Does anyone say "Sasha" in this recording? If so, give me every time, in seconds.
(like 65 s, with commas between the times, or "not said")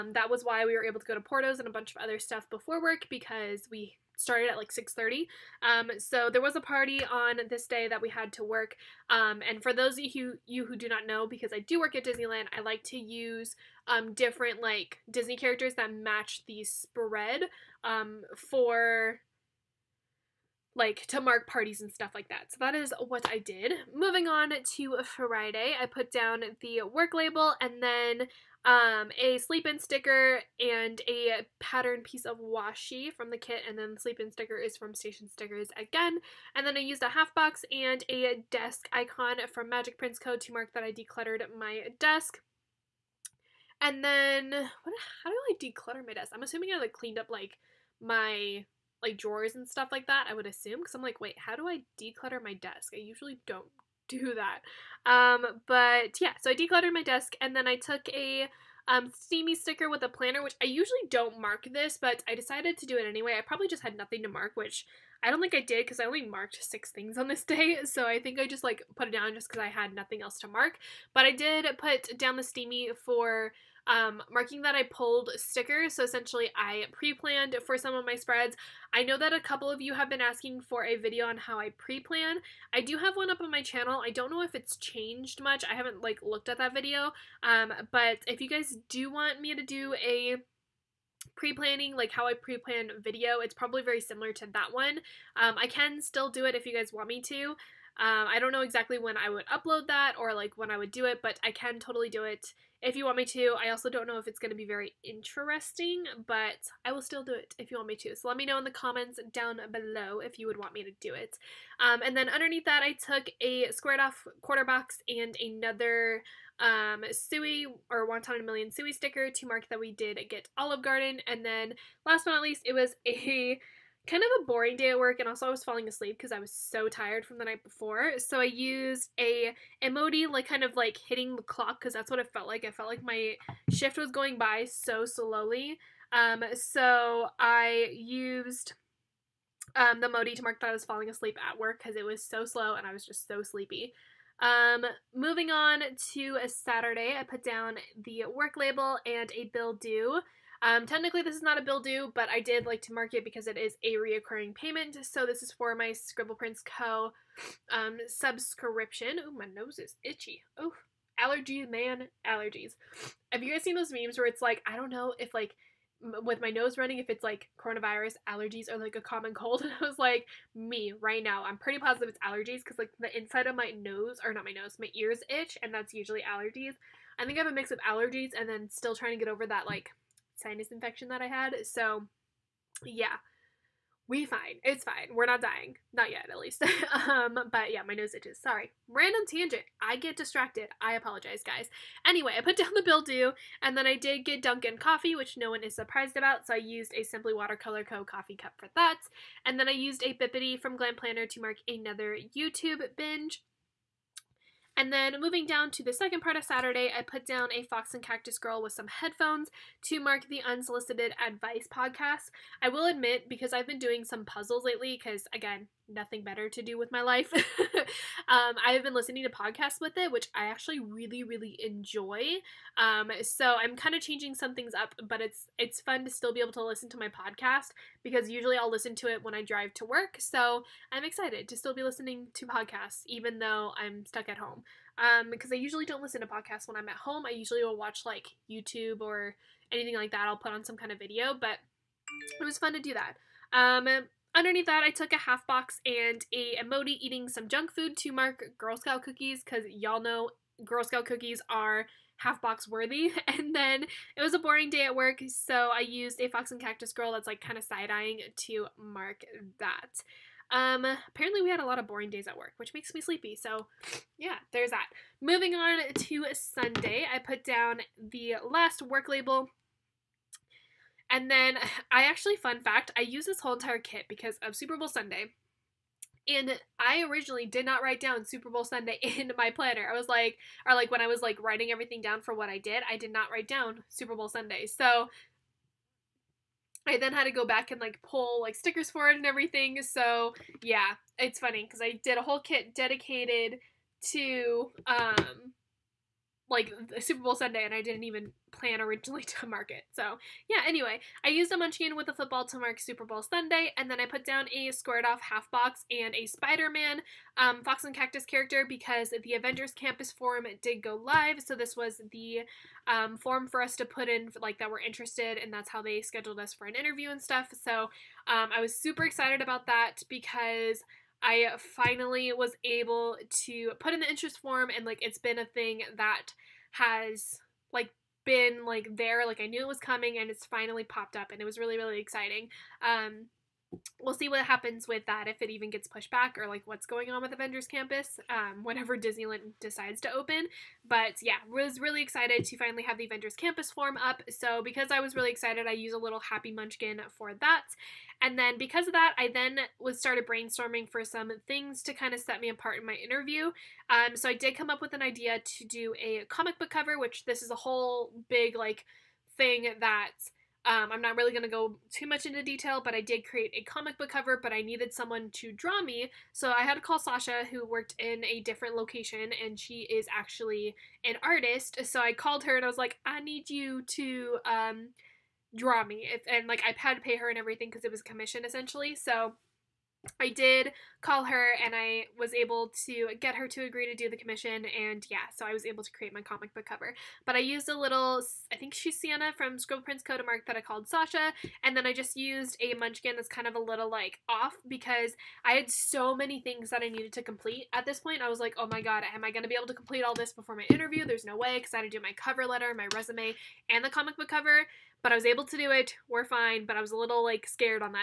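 366 s, 390 s.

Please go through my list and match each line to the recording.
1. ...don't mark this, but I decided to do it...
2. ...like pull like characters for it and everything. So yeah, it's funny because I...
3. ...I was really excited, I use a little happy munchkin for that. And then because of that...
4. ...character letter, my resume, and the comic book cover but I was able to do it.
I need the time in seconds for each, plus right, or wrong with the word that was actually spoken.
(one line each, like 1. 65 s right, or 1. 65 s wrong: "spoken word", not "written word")
1. 61 s right
2. 287 s wrong: "stickers", not "characters"
3. 344 s right
4. 402 s wrong: "cover", not "character".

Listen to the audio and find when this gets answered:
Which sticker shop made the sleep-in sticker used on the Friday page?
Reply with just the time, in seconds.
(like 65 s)
34 s.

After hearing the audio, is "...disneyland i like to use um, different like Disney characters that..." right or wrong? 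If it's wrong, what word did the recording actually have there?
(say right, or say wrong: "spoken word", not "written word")
right.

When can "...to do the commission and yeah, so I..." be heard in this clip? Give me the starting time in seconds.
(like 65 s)
383 s.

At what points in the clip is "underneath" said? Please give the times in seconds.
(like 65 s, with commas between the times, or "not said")
112 s, 244 s.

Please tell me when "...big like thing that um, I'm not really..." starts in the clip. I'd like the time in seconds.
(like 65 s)
358 s.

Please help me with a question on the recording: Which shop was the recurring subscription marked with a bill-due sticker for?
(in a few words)
Scribble Prints Co.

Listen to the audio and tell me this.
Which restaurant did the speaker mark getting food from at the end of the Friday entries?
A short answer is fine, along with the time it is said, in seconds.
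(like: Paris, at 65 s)
Olive Garden, at 120 s.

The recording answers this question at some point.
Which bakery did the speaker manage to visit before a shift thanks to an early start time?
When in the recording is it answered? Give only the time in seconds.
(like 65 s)
1 s.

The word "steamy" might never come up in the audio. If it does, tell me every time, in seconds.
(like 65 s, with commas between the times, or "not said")
59 s, 72 s.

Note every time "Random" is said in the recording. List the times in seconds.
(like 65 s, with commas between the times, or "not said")
188 s.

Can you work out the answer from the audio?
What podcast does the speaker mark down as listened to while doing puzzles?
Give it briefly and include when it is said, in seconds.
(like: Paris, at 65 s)
Unsolicited Advice, at 210 s.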